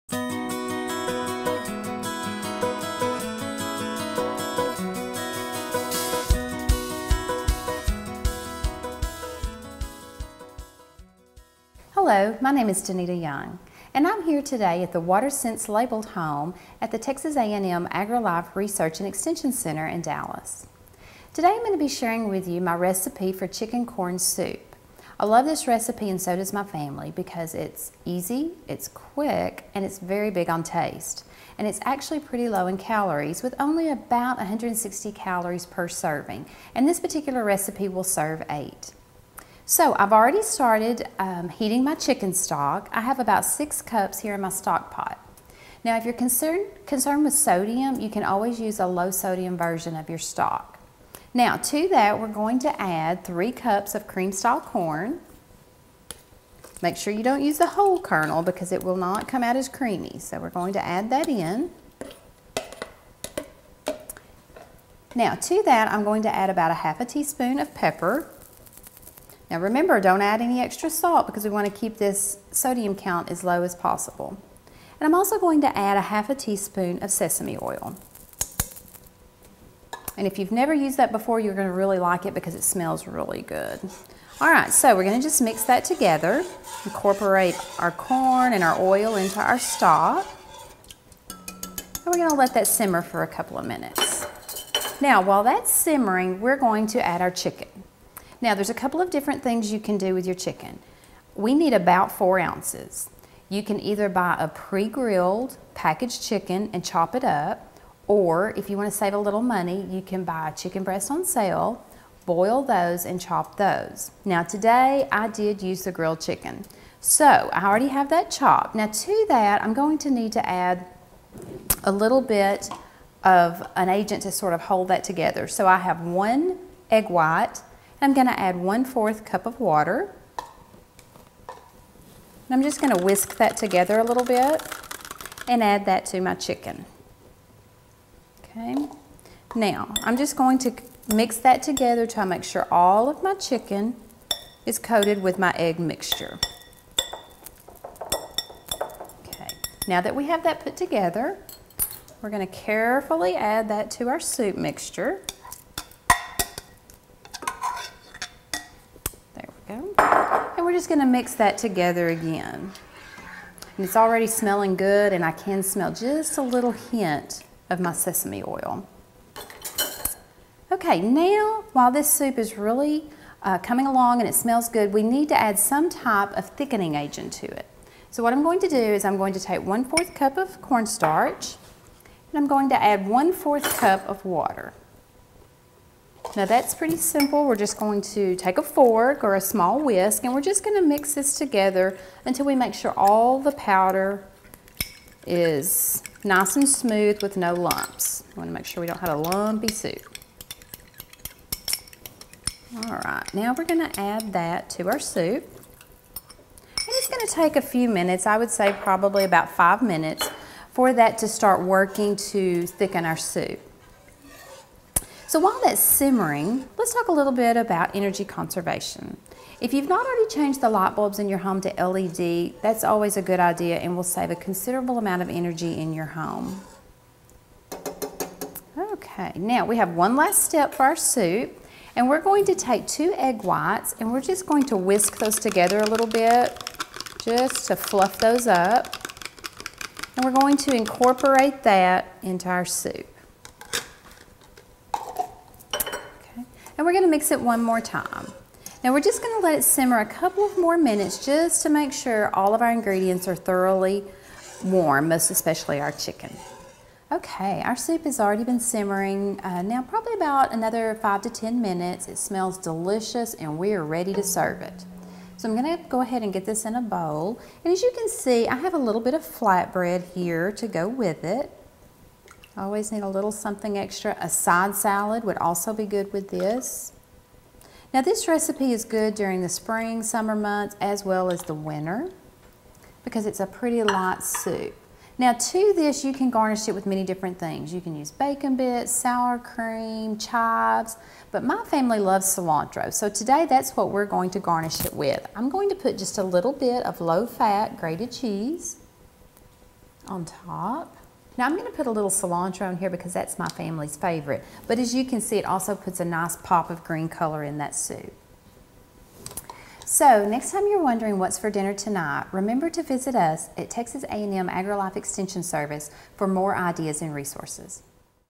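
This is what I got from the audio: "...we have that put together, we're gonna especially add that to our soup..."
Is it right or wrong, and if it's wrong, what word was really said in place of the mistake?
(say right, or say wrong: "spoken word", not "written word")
wrong: "carefully", not "especially".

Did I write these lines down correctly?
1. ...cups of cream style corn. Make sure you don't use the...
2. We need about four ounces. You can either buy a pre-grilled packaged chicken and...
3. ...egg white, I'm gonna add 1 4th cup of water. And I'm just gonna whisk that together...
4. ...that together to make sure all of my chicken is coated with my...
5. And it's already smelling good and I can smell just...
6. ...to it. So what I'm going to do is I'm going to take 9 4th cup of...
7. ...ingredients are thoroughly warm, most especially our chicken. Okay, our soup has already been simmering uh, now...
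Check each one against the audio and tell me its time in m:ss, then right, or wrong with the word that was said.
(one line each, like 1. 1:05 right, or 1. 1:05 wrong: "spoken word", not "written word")
1. 0:53 right
2. 1:41 right
3. 2:06 right
4. 2:21 right
5. 2:43 right
6. 2:57 wrong: "1", not "9"
7. 4:12 right.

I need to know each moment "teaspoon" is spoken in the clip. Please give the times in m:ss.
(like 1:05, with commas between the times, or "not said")
1:07, 1:16.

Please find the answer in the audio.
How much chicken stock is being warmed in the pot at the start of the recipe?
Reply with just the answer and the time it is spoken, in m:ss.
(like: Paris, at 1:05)
6 cups, at 0:43.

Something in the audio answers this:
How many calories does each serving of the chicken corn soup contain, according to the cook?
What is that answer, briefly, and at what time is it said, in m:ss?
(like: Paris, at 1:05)
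160, at 0:34.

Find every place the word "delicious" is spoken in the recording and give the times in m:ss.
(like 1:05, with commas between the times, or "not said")
4:22.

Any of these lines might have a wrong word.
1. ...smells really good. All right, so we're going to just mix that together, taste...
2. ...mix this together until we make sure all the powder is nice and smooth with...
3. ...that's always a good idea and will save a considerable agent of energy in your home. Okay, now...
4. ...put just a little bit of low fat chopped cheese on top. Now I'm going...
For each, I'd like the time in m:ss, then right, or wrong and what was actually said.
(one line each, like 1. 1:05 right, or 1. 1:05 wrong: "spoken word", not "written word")
1. 1:22 wrong: "incorporate", not "taste"
2. 3:10 right
3. 3:42 wrong: "amount", not "agent"
4. 4:55 wrong: "grated", not "chopped".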